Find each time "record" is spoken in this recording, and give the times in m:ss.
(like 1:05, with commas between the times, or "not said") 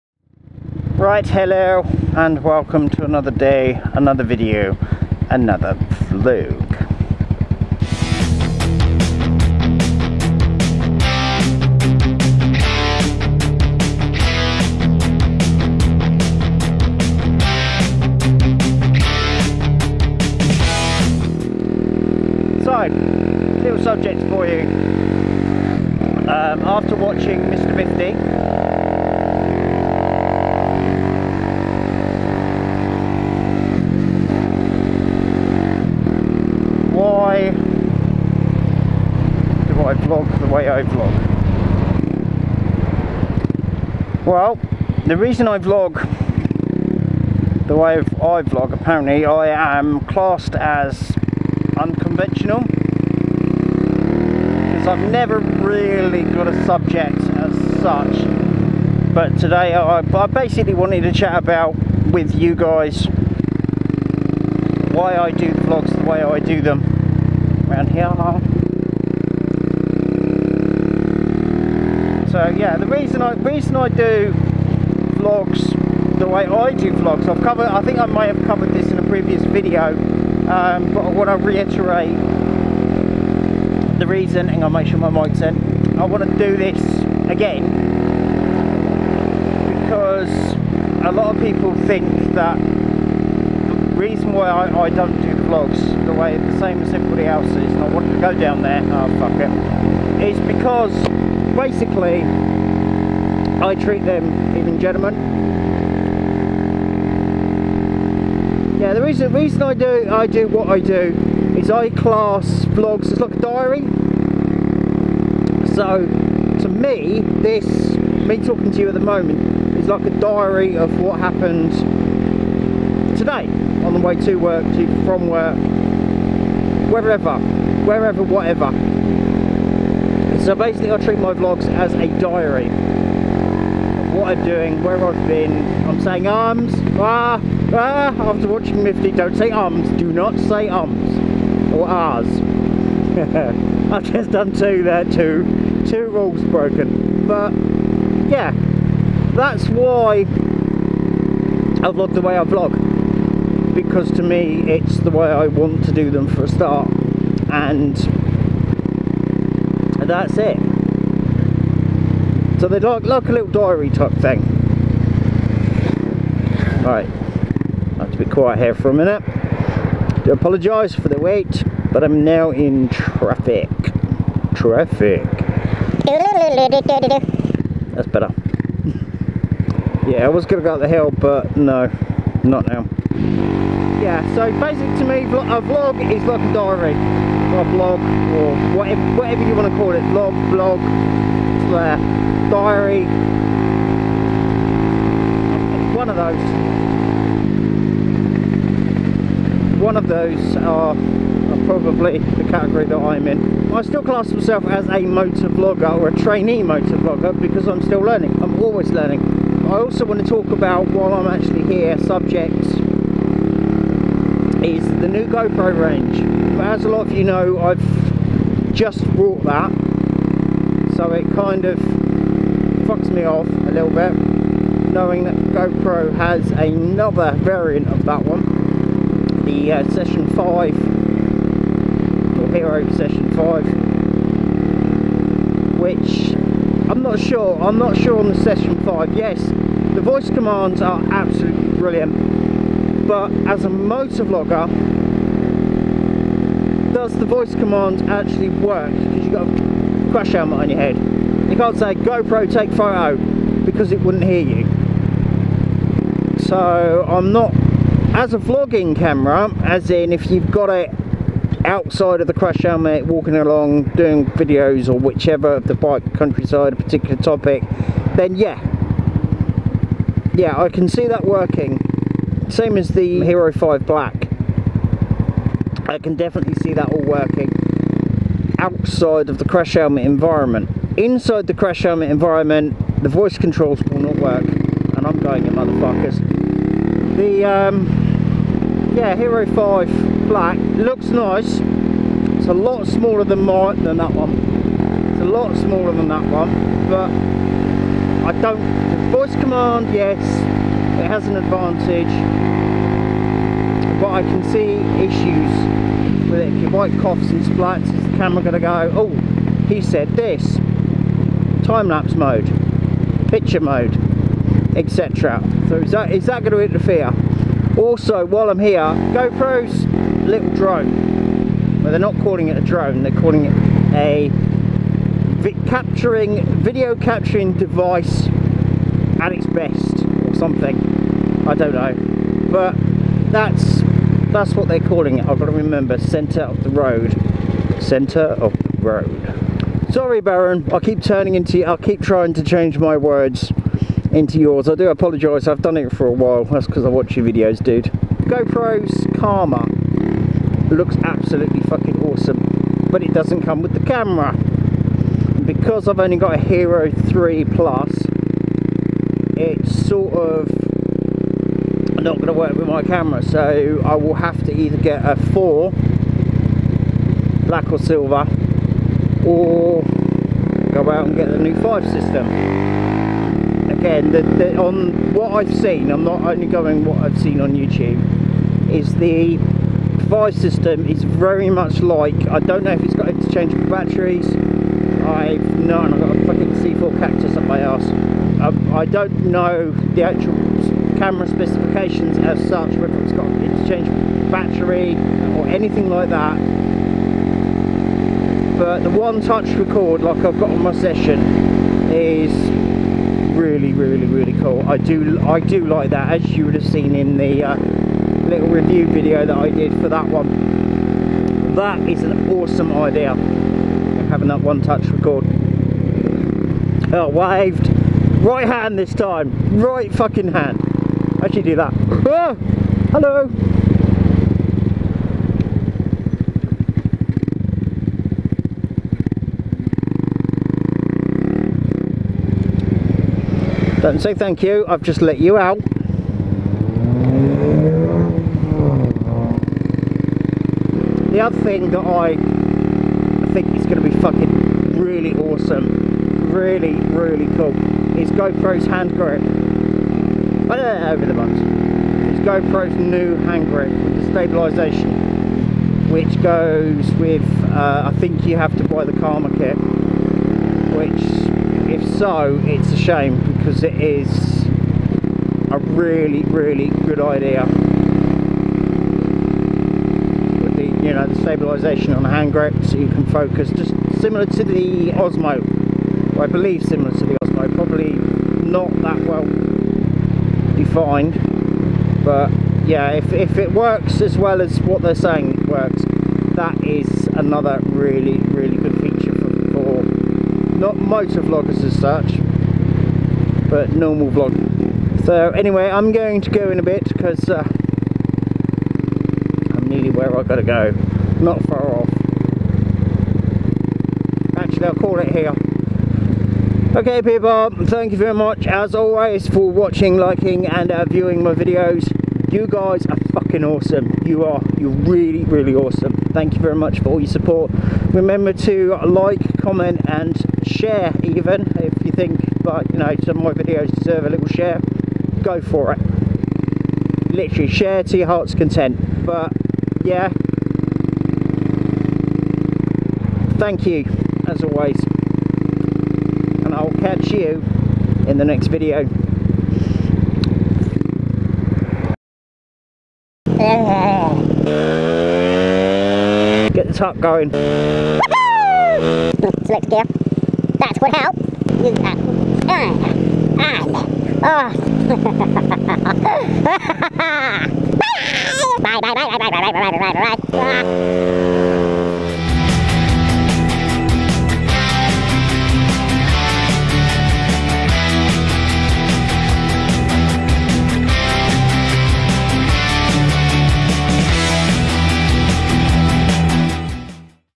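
6:39, 6:54.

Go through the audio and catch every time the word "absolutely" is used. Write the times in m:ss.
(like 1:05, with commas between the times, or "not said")
4:01, 5:51.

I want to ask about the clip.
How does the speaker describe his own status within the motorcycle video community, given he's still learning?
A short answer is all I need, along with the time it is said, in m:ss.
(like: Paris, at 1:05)
trainee motor vlogger, at 3:26.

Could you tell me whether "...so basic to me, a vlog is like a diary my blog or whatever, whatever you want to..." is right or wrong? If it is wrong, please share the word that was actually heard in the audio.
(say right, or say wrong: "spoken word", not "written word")
right.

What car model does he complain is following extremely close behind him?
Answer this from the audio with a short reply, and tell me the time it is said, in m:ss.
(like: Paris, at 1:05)
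C4 Cactus, at 6:26.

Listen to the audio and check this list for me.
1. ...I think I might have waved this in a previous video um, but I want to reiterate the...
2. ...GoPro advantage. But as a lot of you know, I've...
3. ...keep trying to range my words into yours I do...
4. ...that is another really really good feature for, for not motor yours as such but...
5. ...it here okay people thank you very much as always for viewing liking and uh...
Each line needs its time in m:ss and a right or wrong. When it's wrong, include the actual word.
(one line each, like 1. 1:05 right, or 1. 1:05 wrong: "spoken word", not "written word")
1. 1:17 wrong: "covered", not "waved"
2. 3:35 wrong: "range", not "advantage"
3. 5:41 wrong: "change", not "range"
4. 8:06 wrong: "vloggers", not "yours"
5. 8:24 wrong: "watching", not "viewing".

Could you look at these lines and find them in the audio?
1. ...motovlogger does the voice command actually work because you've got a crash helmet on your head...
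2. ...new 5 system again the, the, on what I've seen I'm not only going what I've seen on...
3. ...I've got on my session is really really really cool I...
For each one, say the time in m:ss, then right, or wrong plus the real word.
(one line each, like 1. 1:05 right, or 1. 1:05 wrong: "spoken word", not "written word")
1. 4:03 right
2. 6:11 right
3. 6:40 right.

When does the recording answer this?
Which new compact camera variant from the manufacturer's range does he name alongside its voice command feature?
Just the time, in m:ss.
3:52.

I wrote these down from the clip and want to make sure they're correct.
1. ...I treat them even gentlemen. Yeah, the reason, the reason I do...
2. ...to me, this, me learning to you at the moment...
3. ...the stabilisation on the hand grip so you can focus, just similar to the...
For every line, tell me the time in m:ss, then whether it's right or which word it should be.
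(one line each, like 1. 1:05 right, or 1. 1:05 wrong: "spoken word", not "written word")
1. 1:43 right
2. 1:56 wrong: "talking", not "learning"
3. 7:51 right.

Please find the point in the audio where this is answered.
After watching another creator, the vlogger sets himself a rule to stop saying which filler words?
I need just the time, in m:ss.
2:20.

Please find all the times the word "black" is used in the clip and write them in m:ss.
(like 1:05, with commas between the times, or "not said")
4:33, 4:50, 6:07.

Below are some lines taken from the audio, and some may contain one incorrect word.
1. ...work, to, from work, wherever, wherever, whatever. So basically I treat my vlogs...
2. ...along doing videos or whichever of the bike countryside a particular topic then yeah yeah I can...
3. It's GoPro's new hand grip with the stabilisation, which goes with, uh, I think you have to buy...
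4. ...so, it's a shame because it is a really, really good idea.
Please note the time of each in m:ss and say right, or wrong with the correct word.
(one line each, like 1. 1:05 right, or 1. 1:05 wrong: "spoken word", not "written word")
1. 2:04 right
2. 4:23 right
3. 7:31 right
4. 7:41 right.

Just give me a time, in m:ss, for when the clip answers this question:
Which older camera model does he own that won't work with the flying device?
5:56.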